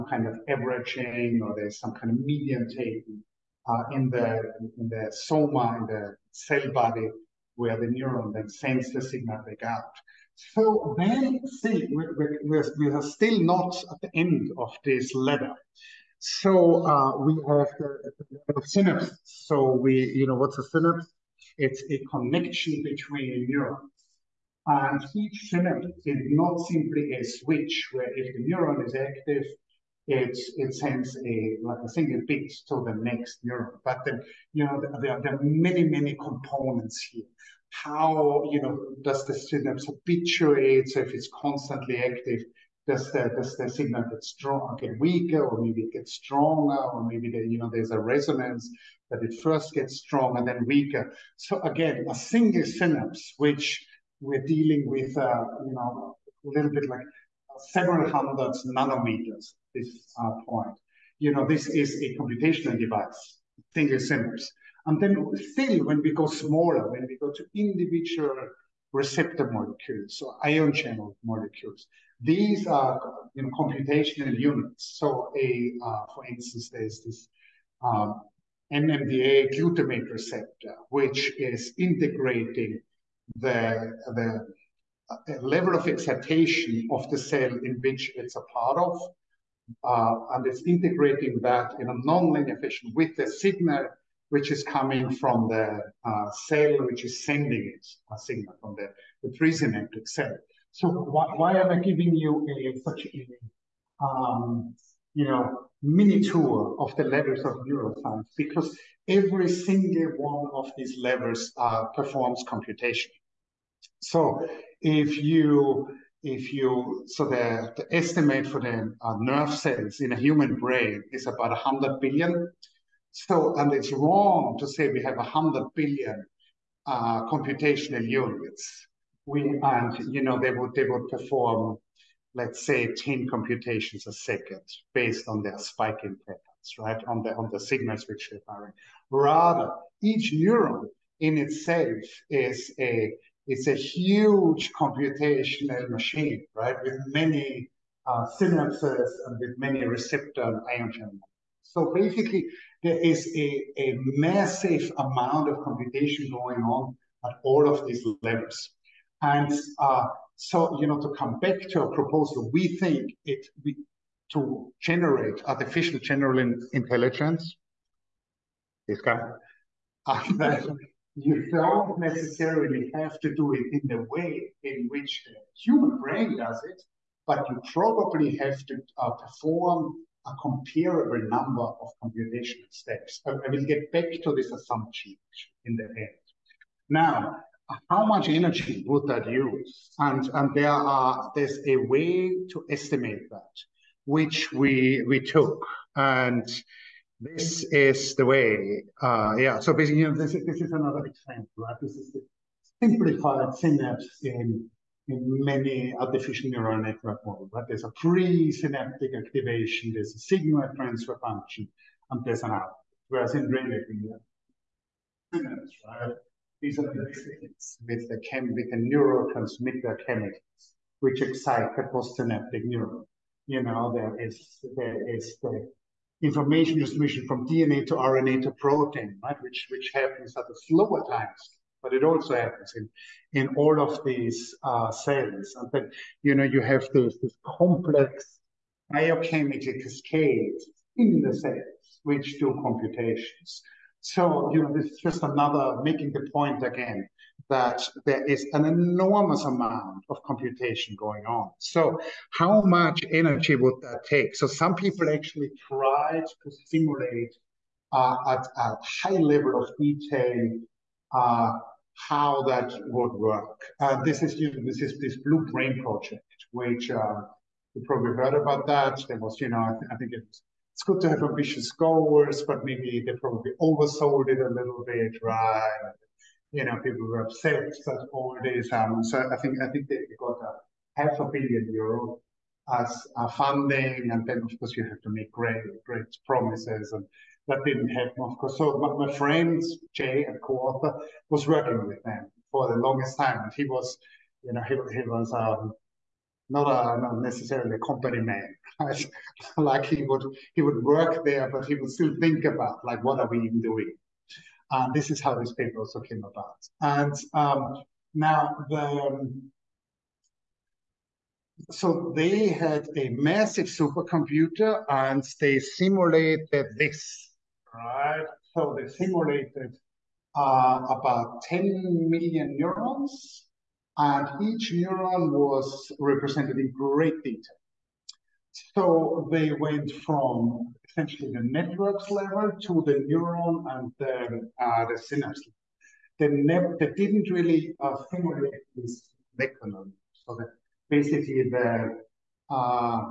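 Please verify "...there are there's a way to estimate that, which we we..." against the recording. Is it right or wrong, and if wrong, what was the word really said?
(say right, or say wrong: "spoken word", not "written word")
right.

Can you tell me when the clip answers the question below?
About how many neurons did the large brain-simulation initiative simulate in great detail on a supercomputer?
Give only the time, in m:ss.
5:21.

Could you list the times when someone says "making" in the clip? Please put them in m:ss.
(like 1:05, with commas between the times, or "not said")
4:05.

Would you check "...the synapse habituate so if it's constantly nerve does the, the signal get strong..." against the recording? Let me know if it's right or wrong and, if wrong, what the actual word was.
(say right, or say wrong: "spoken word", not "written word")
wrong: "active", not "nerve".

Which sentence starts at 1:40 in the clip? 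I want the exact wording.
So why, why am I giving you a, such a, um, you know, mini tour of the levers of neuroscience?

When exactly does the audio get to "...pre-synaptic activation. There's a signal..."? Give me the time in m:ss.
3:27.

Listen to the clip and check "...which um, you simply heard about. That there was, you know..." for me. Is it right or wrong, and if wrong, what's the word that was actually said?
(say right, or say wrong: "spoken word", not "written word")
wrong: "probably", not "simply".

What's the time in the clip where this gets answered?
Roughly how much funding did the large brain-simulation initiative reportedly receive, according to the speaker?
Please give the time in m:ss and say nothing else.
4:40.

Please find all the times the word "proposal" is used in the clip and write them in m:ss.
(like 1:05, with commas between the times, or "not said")
2:41.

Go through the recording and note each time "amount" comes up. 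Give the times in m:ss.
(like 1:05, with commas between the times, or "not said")
2:34, 4:09.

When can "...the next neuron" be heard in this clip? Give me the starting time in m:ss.
0:32.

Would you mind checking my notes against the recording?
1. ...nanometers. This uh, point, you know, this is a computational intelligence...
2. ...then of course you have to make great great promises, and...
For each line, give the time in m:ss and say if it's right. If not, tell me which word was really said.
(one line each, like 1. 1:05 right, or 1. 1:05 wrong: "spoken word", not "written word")
1. 0:58 wrong: "device", not "intelligence"
2. 4:44 right.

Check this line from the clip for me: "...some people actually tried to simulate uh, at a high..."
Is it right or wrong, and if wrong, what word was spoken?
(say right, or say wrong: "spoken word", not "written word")
right.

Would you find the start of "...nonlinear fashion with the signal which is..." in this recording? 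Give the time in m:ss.
1:32.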